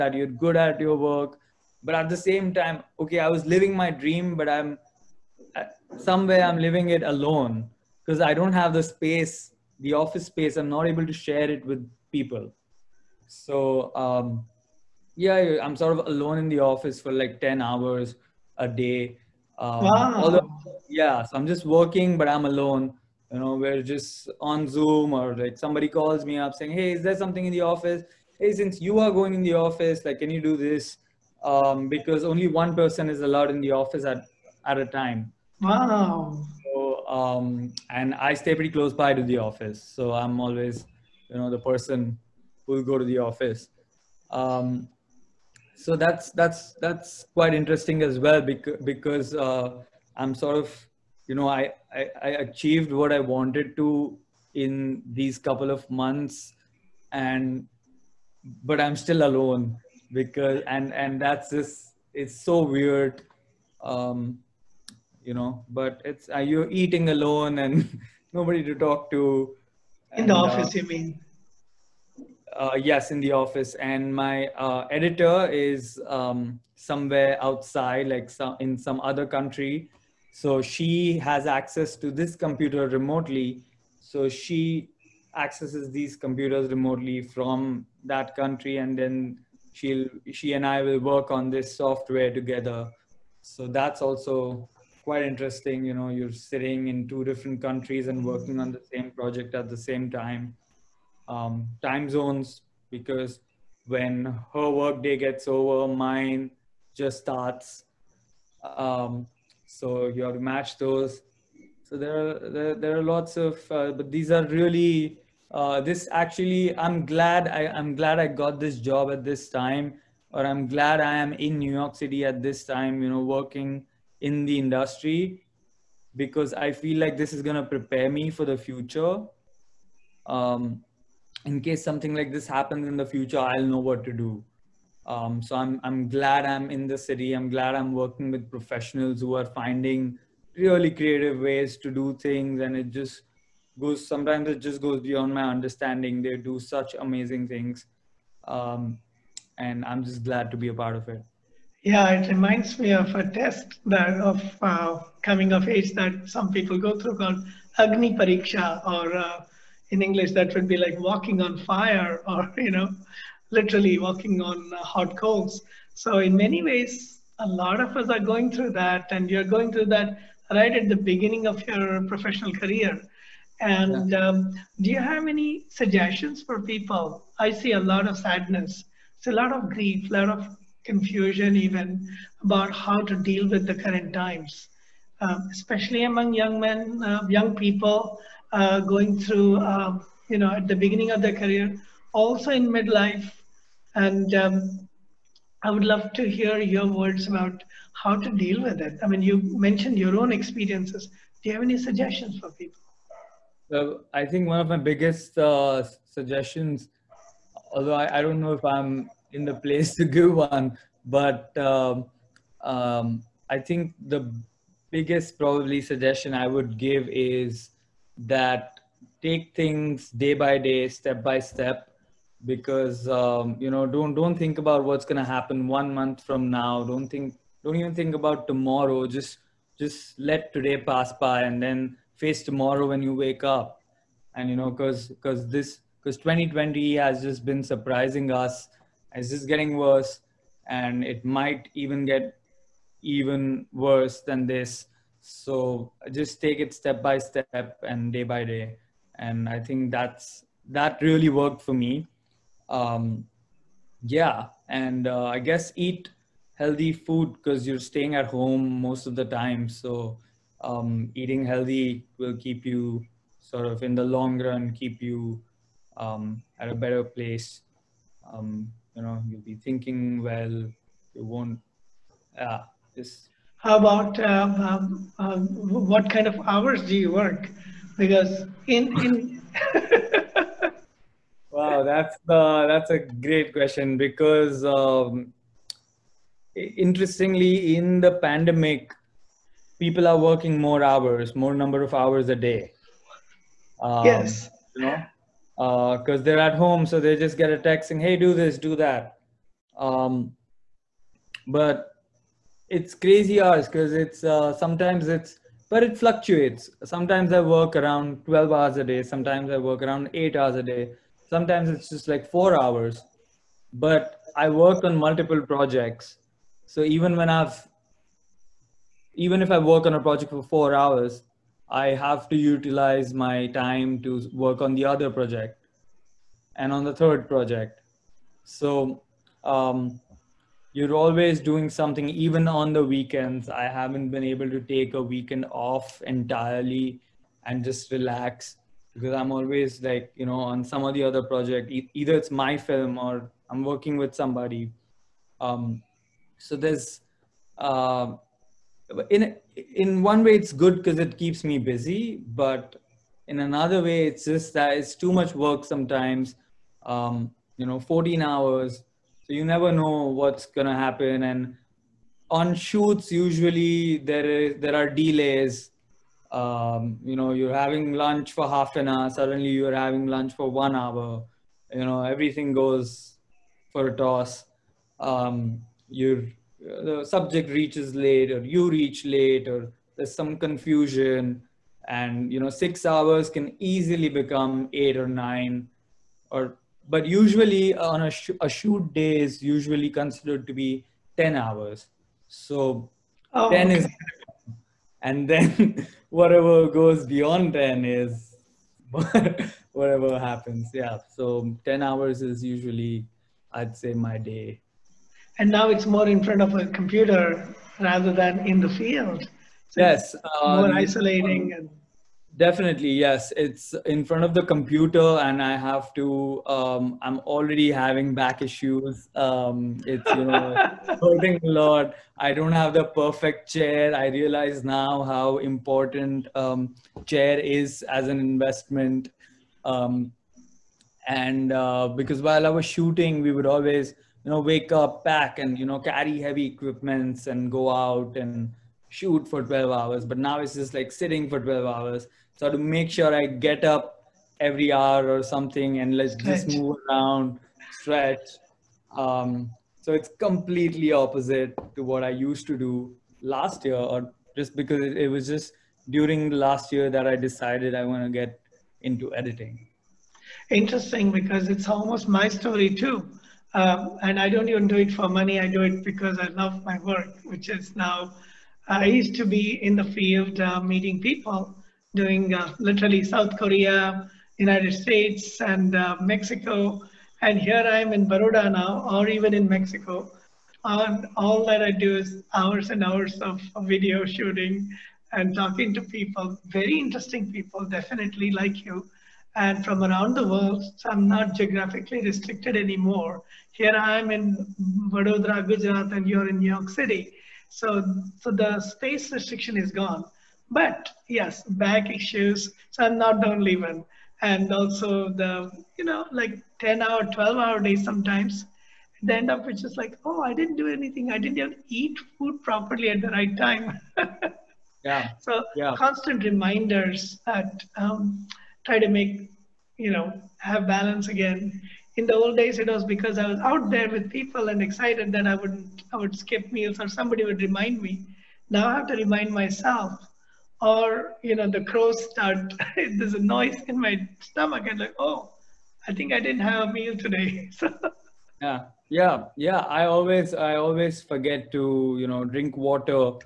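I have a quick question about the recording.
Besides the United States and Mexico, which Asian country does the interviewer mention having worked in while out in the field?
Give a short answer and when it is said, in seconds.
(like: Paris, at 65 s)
South Korea, at 473 s.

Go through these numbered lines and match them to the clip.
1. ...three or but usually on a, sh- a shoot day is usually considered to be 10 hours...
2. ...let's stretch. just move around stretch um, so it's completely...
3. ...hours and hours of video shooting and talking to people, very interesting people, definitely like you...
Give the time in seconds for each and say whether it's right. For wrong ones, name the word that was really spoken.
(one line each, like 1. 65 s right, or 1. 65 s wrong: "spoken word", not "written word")
1. 385 s wrong: "nine", not "three"
2. 445 s right
3. 482 s right.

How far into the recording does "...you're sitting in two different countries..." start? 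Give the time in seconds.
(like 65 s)
96 s.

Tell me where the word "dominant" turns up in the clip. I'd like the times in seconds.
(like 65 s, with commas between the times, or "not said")
not said.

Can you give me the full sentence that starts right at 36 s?
So, um, and I stay pretty close by to the office.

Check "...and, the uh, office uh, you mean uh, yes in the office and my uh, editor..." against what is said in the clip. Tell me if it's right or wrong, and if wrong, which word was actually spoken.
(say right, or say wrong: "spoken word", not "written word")
right.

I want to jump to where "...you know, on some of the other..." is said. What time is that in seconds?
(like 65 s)
340 s.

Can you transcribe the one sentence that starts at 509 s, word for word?
the end up which is like, oh, I didn't do anything.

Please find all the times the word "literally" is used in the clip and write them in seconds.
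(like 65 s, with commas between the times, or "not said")
163 s, 472 s.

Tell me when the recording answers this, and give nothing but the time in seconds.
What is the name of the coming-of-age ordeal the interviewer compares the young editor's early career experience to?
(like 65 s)
157 s.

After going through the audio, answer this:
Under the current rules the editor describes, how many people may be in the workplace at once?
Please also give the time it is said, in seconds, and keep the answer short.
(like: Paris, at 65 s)
1, at 32 s.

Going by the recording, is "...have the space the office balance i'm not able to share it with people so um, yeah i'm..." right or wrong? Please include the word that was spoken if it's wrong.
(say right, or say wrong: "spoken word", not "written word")
wrong: "space", not "balance".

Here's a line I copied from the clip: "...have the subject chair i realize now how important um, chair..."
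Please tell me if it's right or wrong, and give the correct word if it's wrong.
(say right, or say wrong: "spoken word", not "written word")
wrong: "perfect", not "subject".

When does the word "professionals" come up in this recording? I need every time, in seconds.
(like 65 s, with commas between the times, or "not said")
138 s, 172 s.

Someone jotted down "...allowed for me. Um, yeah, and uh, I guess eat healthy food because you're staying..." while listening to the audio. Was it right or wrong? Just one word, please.
wrong.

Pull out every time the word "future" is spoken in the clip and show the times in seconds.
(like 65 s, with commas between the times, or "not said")
128 s, 133 s.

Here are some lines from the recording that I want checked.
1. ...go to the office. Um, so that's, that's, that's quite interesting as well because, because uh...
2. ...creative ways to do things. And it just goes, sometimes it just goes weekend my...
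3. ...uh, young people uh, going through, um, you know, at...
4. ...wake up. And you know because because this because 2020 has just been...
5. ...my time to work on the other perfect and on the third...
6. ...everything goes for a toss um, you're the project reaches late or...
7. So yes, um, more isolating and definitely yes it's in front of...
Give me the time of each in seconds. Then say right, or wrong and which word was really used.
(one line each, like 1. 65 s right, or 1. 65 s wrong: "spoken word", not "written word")
1. 42 s right
2. 140 s wrong: "beyond", not "weekend"
3. 187 s right
4. 233 s right
5. 323 s wrong: "project", not "perfect"
6. 372 s wrong: "subject", not "project"
7. 409 s right.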